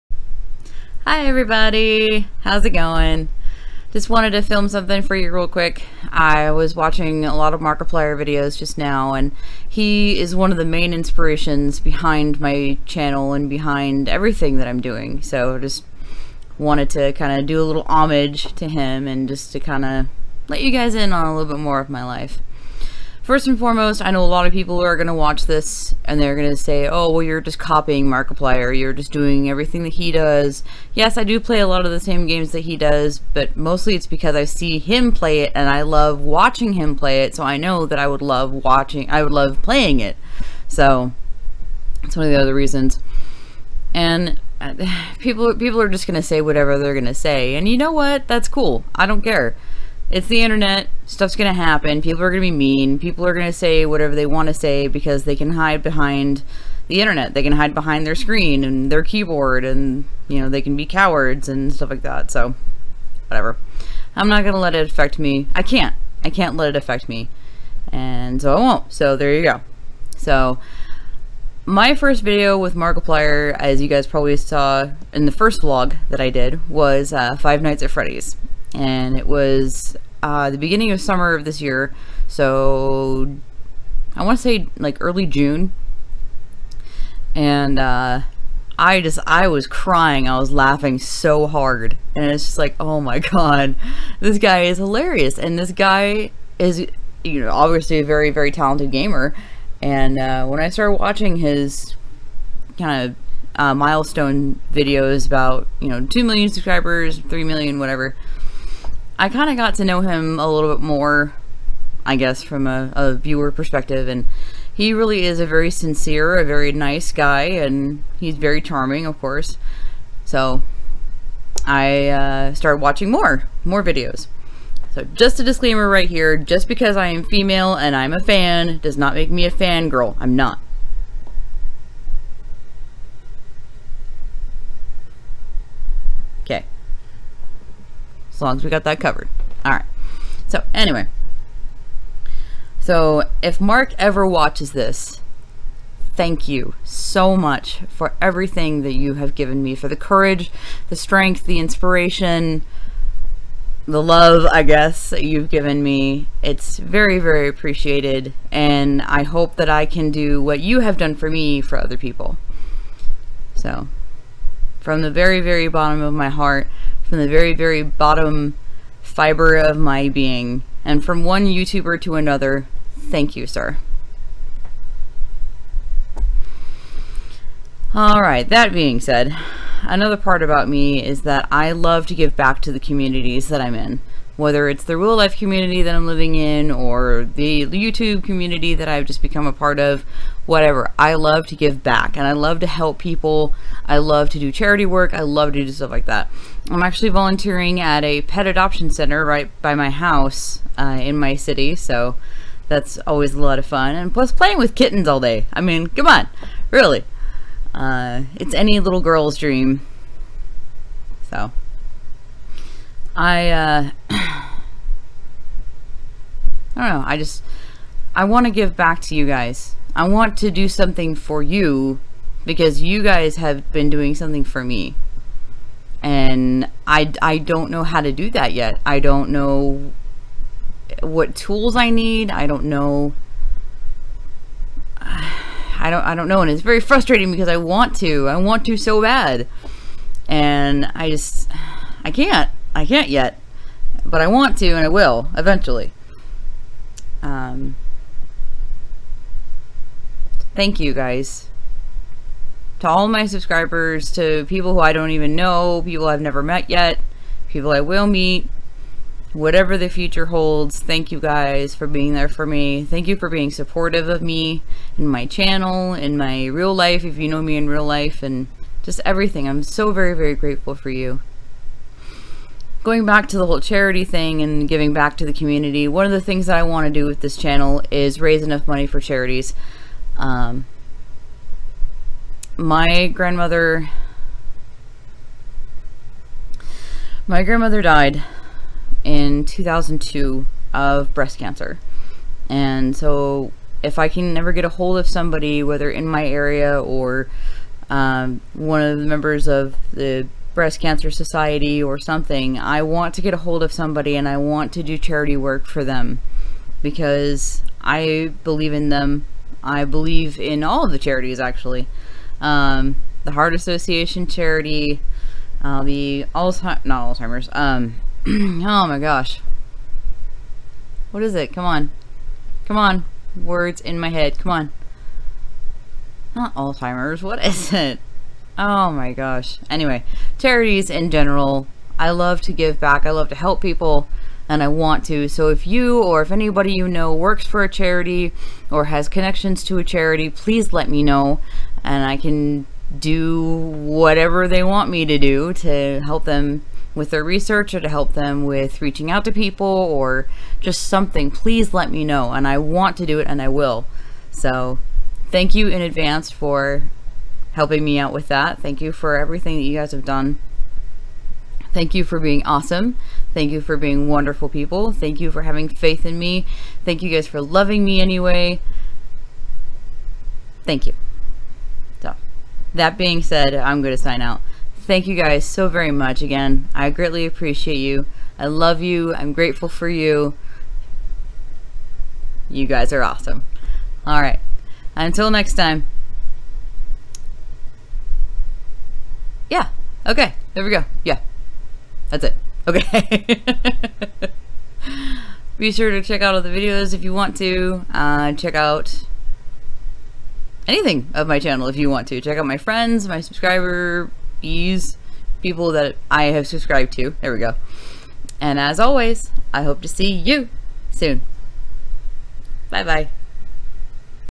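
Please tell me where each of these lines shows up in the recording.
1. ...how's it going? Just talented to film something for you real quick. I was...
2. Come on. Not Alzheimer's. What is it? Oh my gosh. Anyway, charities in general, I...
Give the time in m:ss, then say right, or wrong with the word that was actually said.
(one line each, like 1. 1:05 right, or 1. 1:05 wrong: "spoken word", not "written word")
1. 0:02 wrong: "wanted", not "talented"
2. 5:24 right.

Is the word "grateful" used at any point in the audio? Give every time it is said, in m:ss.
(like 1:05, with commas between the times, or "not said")
4:30, 6:19.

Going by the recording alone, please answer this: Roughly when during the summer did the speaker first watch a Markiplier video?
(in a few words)
Early June.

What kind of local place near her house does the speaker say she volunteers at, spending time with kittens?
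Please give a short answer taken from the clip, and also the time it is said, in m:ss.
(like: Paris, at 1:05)
Pet adoption center, at 3:18.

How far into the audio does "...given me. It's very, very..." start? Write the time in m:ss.
2:35.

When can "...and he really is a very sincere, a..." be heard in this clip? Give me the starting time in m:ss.
1:54.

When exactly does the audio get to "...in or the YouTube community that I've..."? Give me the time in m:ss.
3:06.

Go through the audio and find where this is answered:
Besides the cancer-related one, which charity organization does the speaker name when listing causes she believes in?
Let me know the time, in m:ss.
5:13.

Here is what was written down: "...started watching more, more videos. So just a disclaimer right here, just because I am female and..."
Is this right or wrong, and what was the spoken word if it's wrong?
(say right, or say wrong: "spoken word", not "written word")
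right.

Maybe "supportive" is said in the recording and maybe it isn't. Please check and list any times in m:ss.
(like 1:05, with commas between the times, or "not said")
4:23.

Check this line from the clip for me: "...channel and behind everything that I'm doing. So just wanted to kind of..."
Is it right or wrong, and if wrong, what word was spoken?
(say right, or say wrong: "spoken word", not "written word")
right.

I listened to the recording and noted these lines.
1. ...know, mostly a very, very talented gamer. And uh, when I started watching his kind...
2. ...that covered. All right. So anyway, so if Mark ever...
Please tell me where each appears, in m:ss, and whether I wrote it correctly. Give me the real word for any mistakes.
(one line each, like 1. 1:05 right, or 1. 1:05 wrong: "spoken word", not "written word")
1. 1:37 wrong: "obviously", not "mostly"
2. 2:18 right.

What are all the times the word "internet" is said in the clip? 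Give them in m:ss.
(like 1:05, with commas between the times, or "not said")
0:50, 0:57.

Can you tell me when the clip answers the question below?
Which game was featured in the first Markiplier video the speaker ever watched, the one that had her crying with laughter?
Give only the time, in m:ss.
1:17.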